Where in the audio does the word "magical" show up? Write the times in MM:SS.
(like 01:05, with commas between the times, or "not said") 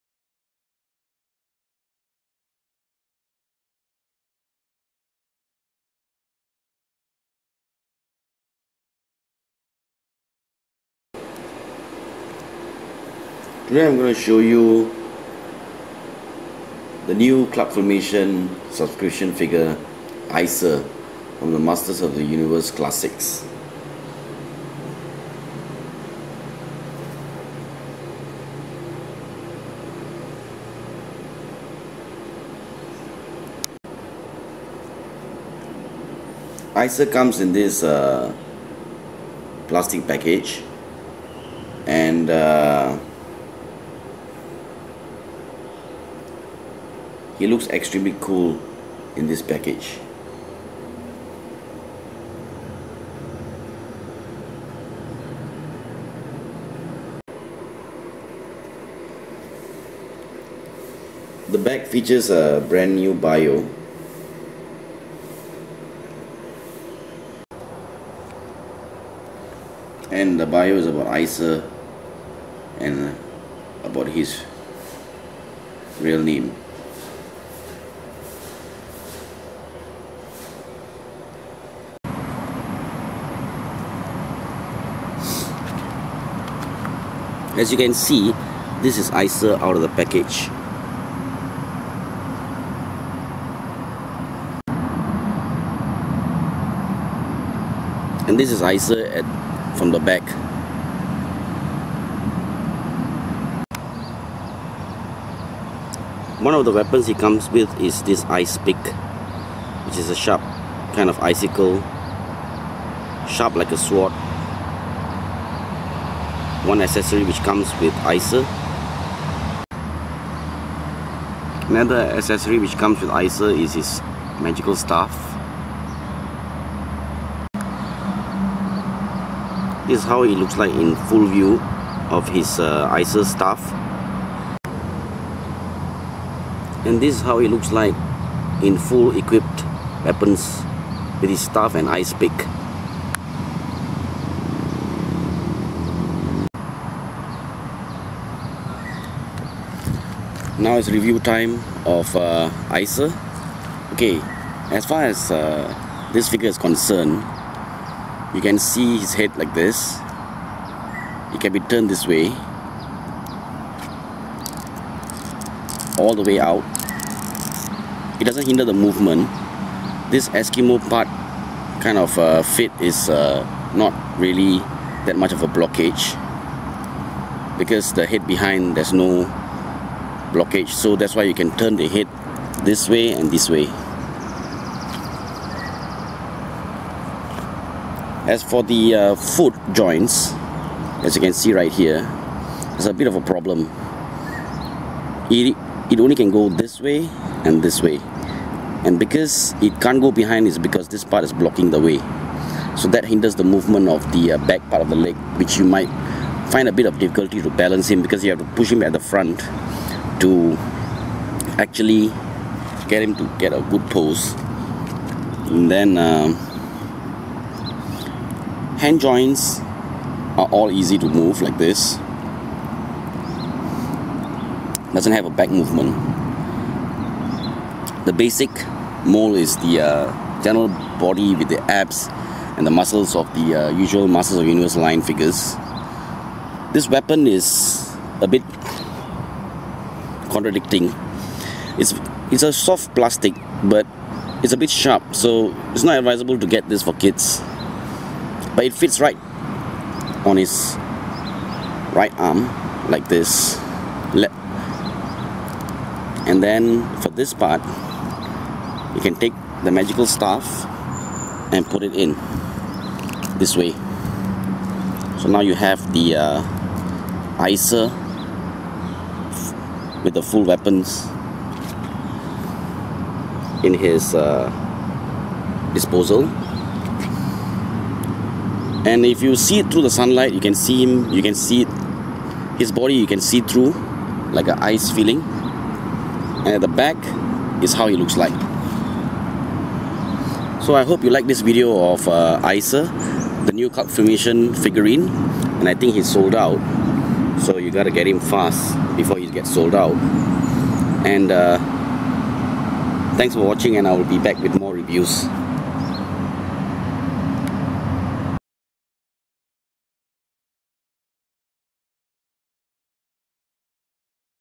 02:04, 04:19.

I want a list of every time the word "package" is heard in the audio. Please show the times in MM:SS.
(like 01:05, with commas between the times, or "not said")
00:40, 00:49, 01:29.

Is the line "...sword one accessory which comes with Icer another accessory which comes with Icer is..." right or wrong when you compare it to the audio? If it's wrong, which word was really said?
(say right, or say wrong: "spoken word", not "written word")
right.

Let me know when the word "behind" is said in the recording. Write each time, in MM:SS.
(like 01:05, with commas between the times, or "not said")
02:58, 03:20.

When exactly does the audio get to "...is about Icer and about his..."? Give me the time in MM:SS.
01:10.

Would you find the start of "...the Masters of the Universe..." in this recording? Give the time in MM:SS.
00:21.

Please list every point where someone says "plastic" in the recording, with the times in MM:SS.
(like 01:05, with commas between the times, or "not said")
00:39, 04:02.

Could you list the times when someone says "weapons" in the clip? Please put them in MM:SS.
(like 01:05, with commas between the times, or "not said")
01:46, 02:20, 03:56, 04:30.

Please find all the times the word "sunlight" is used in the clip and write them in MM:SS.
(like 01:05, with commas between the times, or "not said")
04:39.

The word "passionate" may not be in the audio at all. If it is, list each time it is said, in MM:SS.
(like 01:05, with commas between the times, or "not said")
not said.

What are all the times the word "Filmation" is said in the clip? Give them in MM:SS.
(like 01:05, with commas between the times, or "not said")
00:17, 04:53.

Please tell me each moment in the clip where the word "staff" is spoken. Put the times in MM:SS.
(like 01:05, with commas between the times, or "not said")
02:04, 02:13, 02:21, 04:20.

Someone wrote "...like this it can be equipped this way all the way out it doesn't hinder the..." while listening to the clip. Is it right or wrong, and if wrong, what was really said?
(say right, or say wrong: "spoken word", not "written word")
wrong: "turned", not "equipped".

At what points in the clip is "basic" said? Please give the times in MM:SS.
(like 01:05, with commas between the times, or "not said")
03:48.